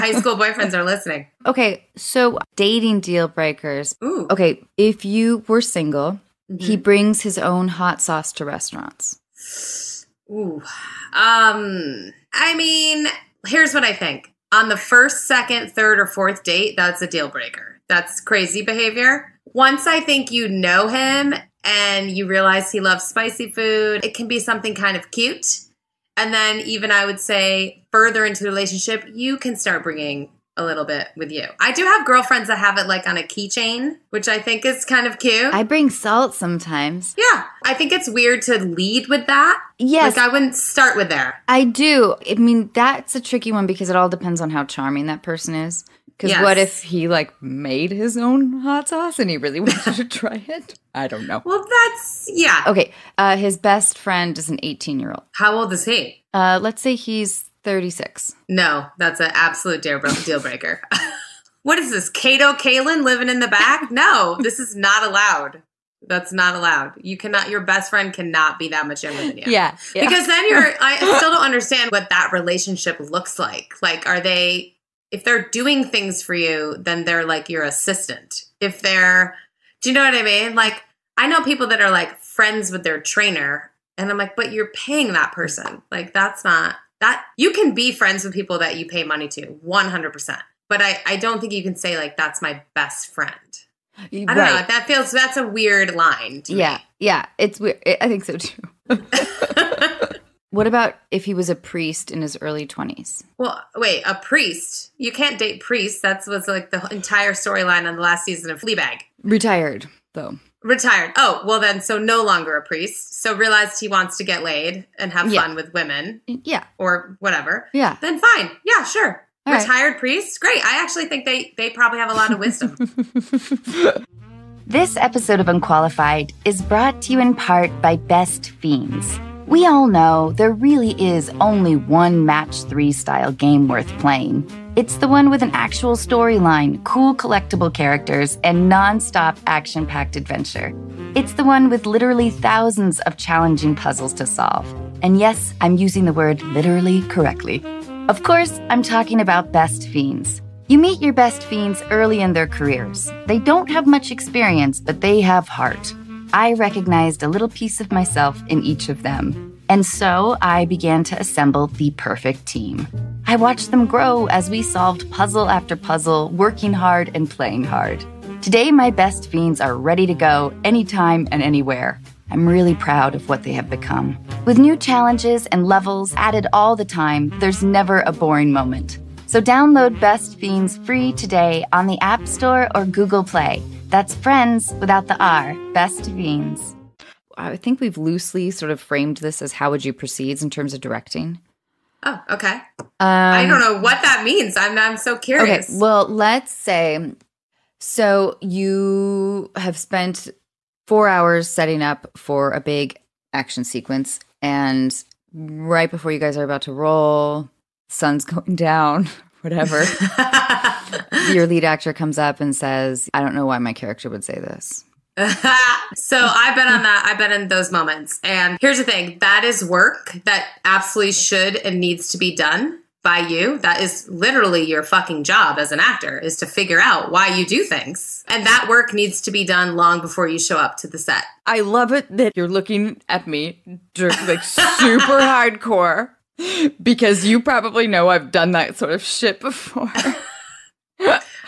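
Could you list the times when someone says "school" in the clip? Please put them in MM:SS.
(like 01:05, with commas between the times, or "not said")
00:00.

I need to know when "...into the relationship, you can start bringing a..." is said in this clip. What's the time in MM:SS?
00:28.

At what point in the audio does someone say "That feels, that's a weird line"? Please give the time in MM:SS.
01:34.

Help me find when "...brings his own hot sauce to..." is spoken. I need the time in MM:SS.
00:06.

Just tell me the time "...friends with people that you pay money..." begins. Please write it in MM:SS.
01:27.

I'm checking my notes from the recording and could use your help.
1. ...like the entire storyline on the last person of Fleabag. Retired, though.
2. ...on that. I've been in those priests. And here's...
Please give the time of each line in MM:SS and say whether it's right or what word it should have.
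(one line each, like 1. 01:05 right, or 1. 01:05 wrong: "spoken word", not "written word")
1. 01:46 wrong: "season", not "person"
2. 03:36 wrong: "moments", not "priests".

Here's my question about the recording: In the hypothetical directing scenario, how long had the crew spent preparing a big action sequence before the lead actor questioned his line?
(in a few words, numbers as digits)
4 hours.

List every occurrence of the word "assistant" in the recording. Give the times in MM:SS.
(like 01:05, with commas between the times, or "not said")
01:17.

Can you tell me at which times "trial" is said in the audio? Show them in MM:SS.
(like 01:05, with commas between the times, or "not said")
not said.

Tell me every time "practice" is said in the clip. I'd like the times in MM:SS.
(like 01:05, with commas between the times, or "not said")
not said.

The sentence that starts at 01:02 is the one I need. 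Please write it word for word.
Kato Kaelin living in the back?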